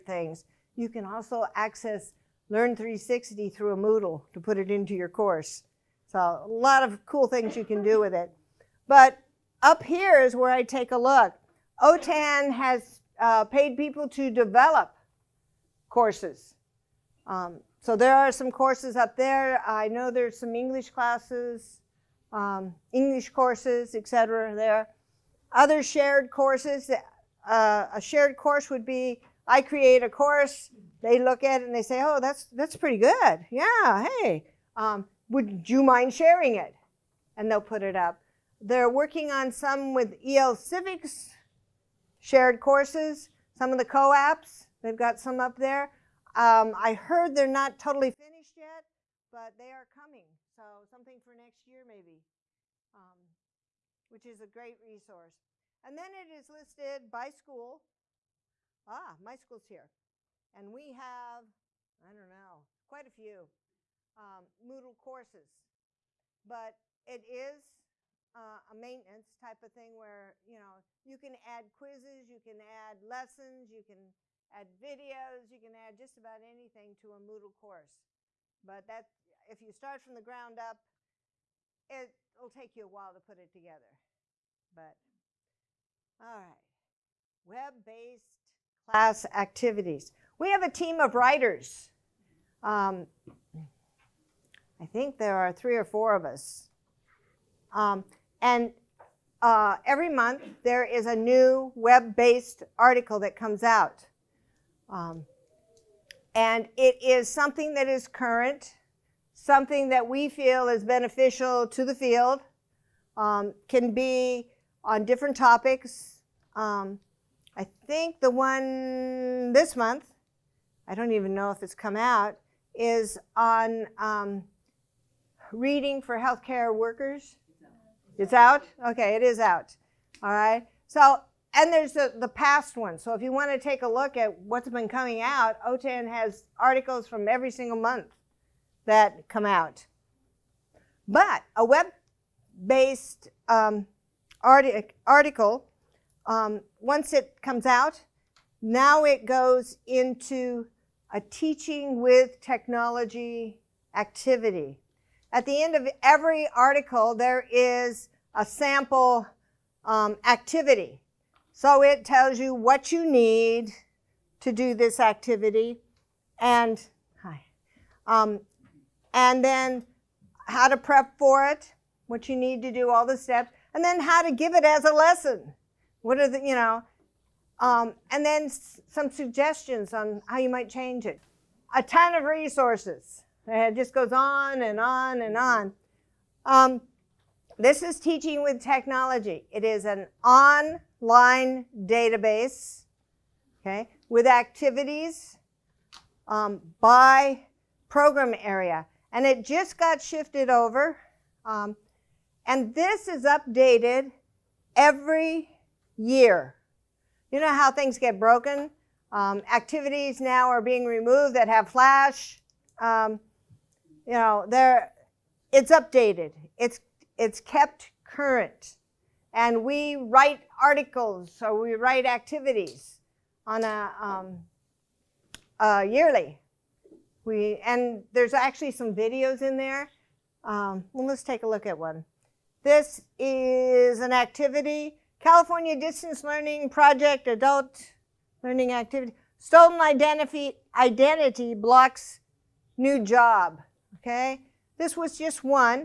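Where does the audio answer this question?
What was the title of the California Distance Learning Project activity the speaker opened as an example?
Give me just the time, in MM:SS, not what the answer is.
03:59.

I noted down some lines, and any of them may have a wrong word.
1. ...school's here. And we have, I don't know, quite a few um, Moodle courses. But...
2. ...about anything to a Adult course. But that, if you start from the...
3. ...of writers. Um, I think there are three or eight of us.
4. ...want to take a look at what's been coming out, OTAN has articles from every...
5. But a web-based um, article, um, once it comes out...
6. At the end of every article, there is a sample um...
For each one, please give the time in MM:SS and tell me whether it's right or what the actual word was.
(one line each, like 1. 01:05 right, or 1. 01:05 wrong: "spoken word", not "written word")
1. 00:59 right
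2. 01:16 wrong: "Moodle", not "Adult"
3. 01:30 wrong: "four", not "eight"
4. 02:13 right
5. 02:21 right
6. 02:35 right.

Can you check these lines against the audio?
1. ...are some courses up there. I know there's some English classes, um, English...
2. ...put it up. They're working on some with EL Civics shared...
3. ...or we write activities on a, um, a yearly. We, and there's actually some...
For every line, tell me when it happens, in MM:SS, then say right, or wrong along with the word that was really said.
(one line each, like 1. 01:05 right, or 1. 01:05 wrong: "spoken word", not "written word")
1. 00:18 right
2. 00:37 right
3. 03:41 right.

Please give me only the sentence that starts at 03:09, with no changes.
It is an on line database, okay, with activities um, by program area.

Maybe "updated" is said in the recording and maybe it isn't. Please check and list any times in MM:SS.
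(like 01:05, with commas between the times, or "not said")
03:23, 03:35.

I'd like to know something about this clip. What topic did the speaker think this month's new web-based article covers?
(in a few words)
Reading for healthcare workers.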